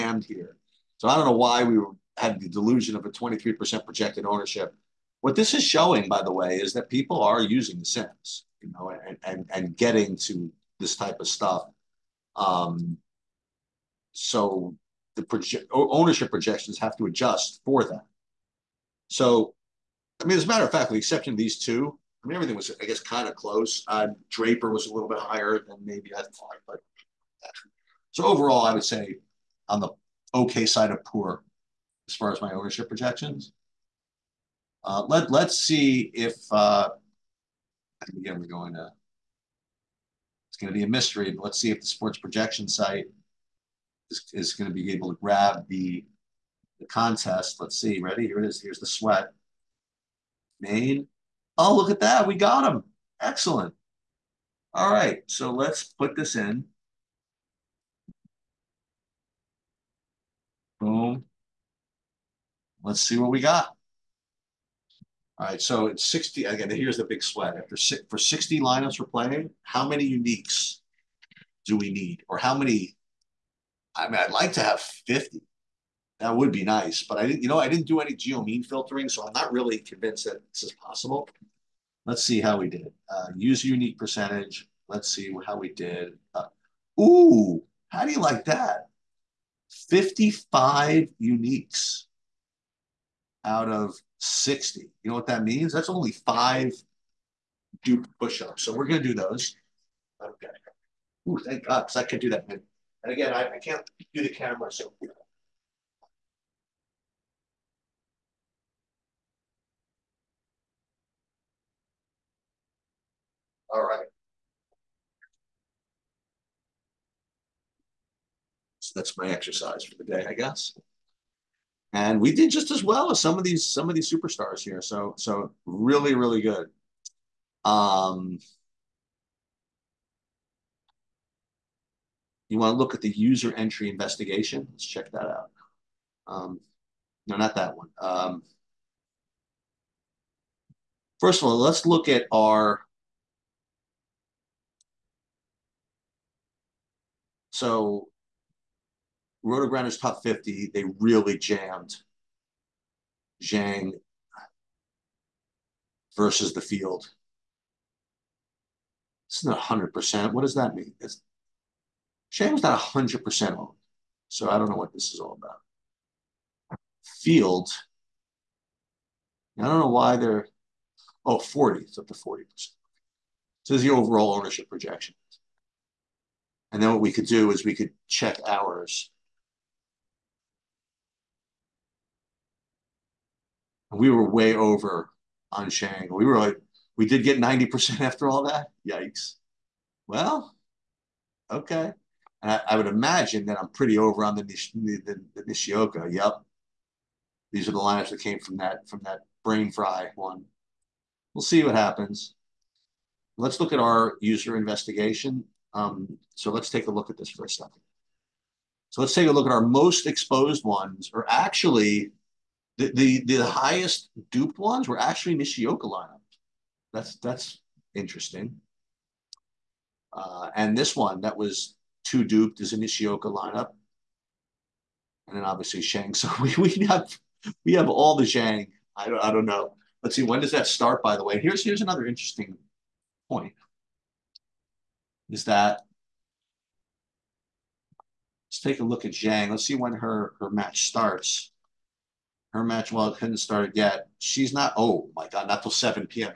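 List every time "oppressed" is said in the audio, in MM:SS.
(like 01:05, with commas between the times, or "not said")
not said.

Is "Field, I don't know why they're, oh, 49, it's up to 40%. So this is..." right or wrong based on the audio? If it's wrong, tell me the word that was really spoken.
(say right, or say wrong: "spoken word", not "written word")
wrong: "40", not "49".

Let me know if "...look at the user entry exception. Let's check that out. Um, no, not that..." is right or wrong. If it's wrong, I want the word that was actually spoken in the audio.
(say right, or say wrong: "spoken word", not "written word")
wrong: "investigation", not "exception".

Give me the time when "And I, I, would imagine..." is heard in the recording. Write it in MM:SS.
03:12.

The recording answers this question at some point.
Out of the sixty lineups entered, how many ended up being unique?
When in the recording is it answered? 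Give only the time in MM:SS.
01:29.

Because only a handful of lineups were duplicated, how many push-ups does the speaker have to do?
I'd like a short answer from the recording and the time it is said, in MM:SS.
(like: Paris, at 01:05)
5, at 01:36.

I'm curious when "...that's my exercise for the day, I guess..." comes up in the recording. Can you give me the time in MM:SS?
01:58.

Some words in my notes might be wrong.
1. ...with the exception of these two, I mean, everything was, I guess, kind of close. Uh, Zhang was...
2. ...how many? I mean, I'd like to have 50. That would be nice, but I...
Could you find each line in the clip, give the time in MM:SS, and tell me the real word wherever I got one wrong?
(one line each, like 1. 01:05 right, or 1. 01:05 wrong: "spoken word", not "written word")
1. 00:20 wrong: "Draper", not "Zhang"
2. 01:12 right.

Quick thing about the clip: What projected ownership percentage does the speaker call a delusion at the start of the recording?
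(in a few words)
23%.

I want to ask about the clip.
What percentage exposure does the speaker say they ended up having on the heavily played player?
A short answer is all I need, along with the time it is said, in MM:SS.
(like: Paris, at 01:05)
90%, at 03:07.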